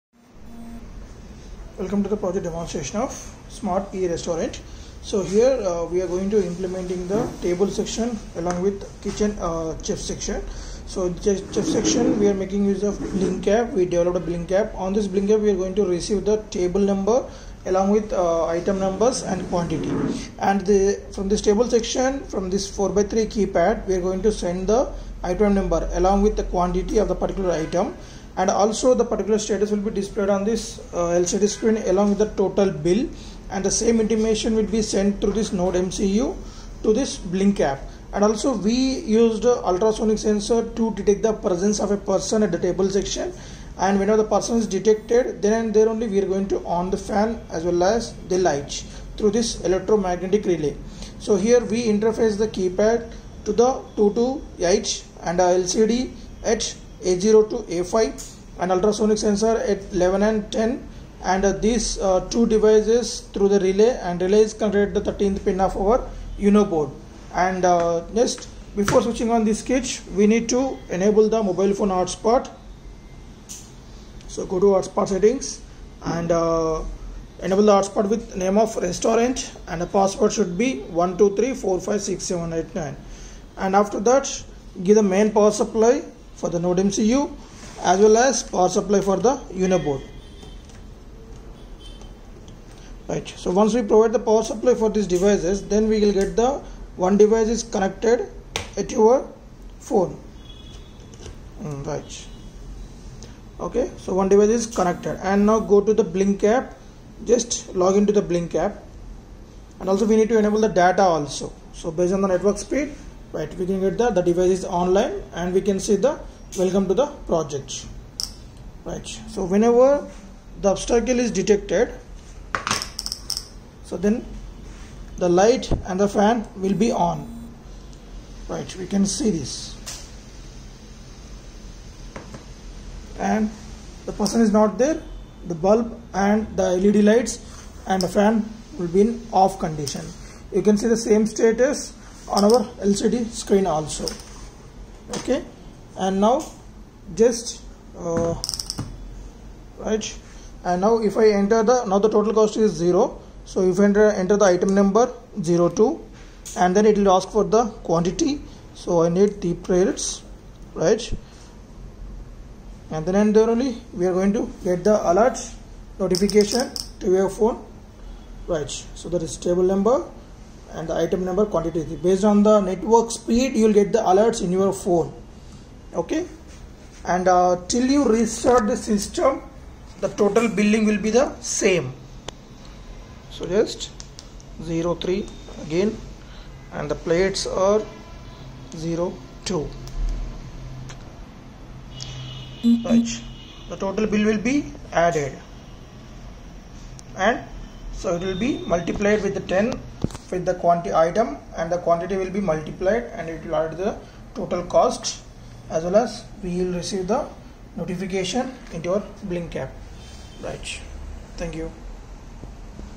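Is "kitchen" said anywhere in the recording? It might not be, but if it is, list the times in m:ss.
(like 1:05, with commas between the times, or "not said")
0:09.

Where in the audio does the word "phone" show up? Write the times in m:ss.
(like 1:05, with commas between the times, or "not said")
1:11, 1:39, 2:47, 2:54.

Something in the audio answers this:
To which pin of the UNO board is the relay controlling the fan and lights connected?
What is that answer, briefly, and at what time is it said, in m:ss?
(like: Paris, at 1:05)
13, at 1:05.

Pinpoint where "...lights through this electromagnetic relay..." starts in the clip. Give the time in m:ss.
0:48.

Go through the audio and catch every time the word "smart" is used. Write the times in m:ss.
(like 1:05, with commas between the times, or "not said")
0:03.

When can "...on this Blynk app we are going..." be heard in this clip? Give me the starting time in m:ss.
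0:14.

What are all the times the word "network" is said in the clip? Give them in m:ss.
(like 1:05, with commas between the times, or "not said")
1:52, 2:52.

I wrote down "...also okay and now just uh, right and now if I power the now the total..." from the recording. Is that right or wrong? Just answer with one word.
wrong.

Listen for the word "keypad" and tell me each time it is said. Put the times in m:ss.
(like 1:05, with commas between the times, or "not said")
0:23, 0:52.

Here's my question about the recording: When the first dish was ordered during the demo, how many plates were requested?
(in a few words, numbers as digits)
3.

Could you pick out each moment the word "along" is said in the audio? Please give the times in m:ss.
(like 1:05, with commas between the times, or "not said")
0:08, 0:17, 0:25, 0:31.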